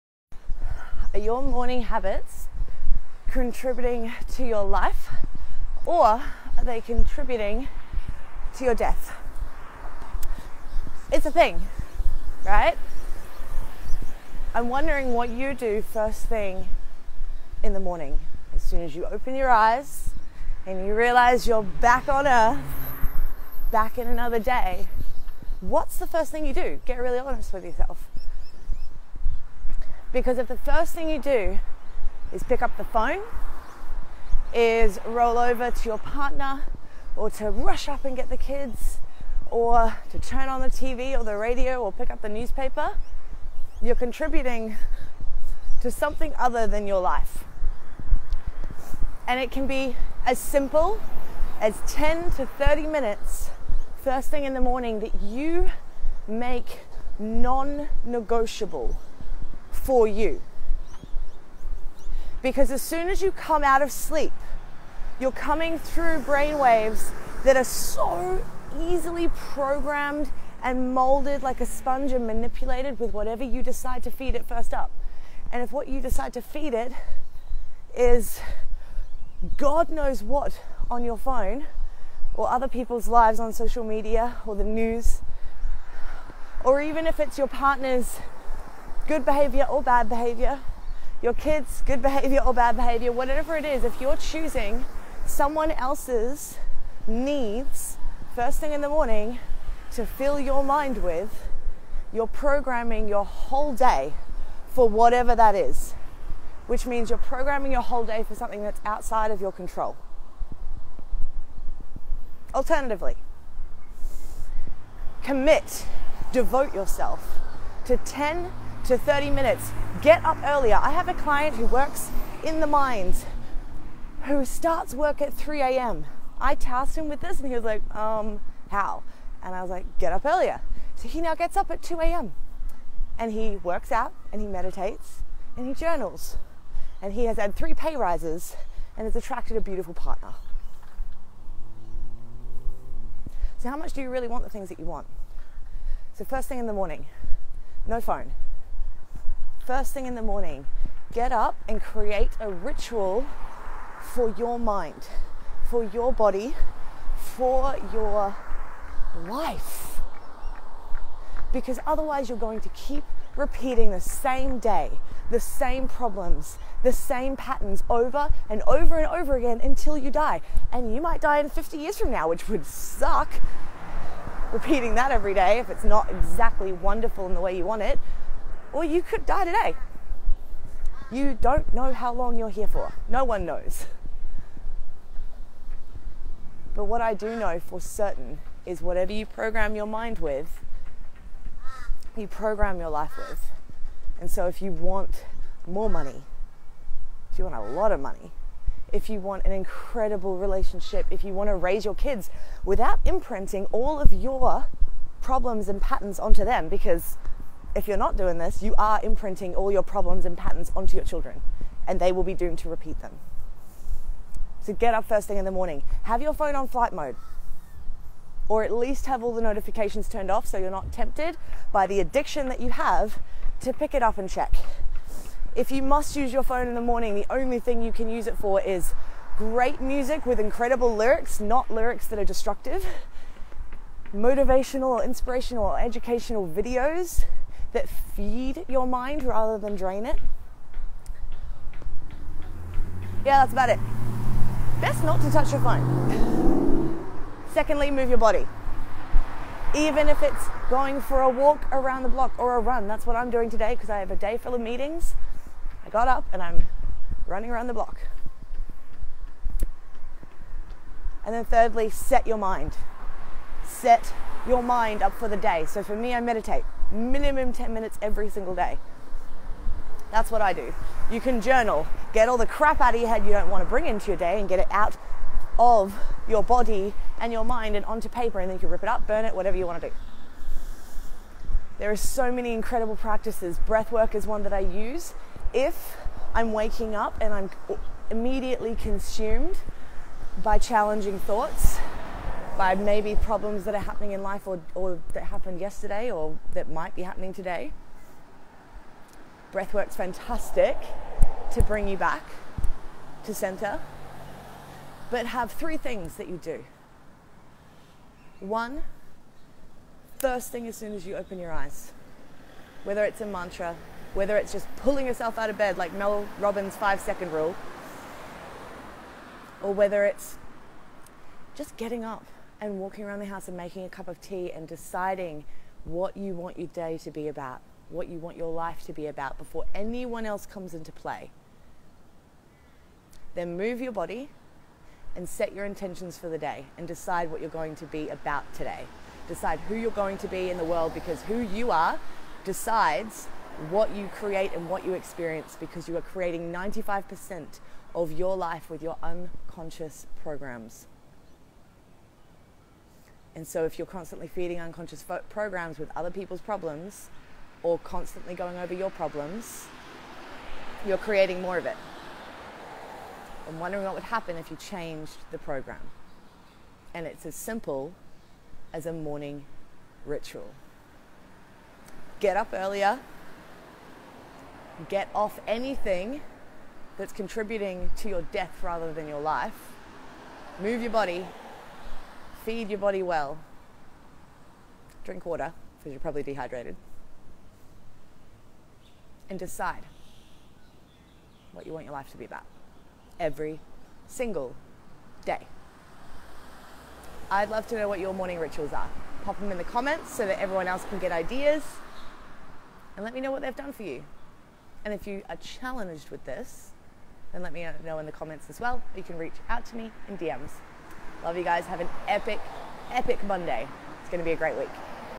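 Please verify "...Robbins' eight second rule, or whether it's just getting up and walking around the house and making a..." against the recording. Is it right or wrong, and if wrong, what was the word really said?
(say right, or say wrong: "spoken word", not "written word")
wrong: "five", not "eight".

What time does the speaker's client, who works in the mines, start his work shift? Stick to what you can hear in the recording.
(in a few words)
3 a.m.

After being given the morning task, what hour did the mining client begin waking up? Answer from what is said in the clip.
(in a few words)
2 a.m.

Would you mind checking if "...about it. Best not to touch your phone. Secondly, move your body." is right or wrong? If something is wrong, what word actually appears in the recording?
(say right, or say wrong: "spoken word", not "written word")
right.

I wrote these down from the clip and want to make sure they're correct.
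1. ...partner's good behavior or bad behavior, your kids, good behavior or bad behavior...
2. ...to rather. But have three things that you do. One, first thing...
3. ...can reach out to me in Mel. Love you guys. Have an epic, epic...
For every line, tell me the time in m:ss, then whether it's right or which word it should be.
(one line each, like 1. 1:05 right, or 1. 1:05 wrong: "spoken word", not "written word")
1. 1:27 right
2. 5:03 wrong: "center", not "rather"
3. 6:49 wrong: "DMs", not "Mel".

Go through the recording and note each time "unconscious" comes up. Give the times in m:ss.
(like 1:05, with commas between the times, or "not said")
5:49, 5:54.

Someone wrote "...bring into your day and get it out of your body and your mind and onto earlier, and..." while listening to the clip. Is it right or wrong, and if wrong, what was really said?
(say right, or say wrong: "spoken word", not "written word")
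wrong: "paper", not "earlier".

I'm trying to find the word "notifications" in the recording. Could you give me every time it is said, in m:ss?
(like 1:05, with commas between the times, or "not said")
3:39.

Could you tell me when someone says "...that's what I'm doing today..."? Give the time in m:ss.
4:12.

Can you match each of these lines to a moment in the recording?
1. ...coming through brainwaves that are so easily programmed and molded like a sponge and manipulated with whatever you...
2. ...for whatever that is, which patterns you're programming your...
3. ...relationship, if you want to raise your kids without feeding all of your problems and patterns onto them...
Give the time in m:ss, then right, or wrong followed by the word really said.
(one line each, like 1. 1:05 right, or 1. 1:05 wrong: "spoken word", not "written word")
1. 1:05 right
2. 1:44 wrong: "means", not "patterns"
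3. 3:20 wrong: "imprinting", not "feeding".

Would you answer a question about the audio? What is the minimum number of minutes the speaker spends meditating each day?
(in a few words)
10 minutes.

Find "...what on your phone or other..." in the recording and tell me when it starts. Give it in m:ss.
1:20.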